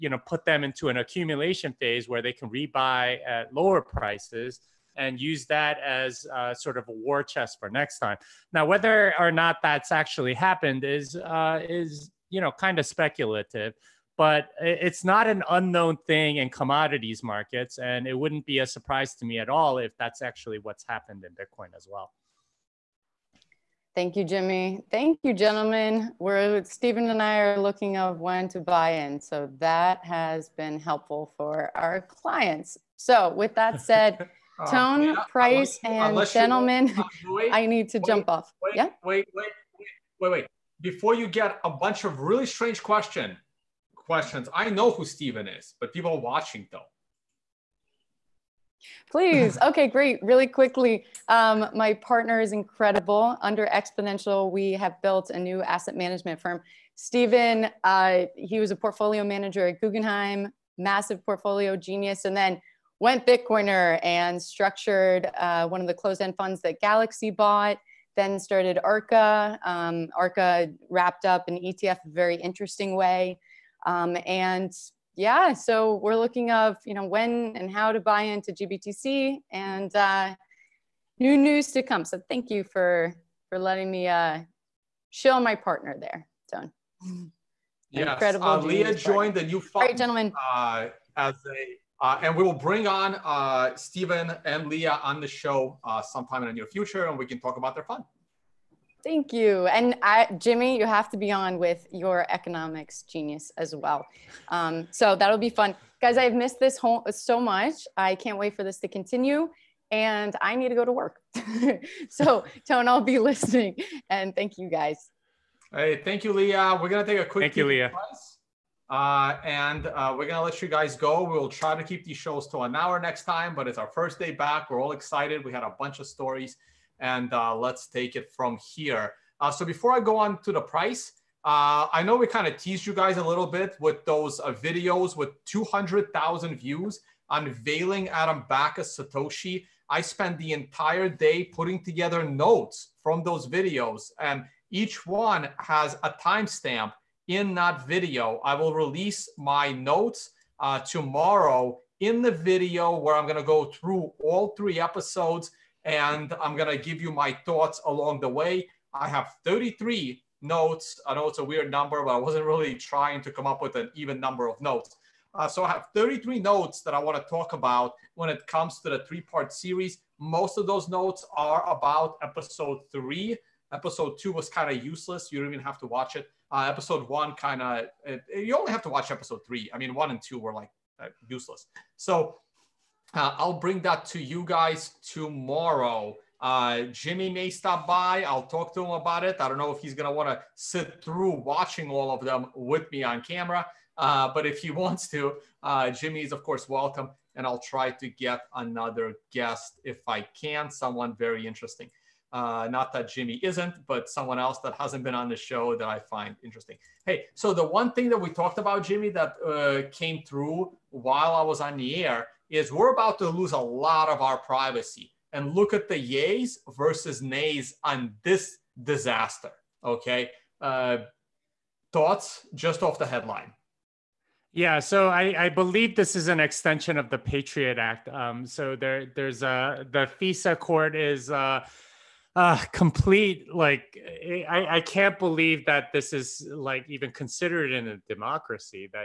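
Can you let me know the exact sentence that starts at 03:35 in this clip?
And look at the yays versus nays on this disaster.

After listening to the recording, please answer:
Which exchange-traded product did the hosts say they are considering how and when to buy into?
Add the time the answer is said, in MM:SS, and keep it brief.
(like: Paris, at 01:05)
GBTC, at 01:18.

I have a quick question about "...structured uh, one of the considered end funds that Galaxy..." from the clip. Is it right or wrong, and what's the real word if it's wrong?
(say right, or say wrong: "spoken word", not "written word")
wrong: "closed", not "considered".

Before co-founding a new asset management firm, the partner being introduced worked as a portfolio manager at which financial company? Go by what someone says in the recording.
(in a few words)
Guggenheim.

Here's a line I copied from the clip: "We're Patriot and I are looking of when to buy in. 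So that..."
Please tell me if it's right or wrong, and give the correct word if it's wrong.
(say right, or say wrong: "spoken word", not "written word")
wrong: "Stephen", not "Patriot".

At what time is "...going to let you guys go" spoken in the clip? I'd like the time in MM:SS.
02:00.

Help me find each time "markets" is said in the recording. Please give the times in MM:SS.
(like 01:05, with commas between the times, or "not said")
00:17.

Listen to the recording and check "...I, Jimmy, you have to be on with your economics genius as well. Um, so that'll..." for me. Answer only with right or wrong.
right.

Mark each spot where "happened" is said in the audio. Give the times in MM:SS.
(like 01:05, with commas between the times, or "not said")
00:10, 00:20.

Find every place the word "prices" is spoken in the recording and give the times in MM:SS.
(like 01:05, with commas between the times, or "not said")
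00:03, 00:35, 02:10.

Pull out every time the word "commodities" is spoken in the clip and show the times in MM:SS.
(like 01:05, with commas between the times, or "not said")
00:16.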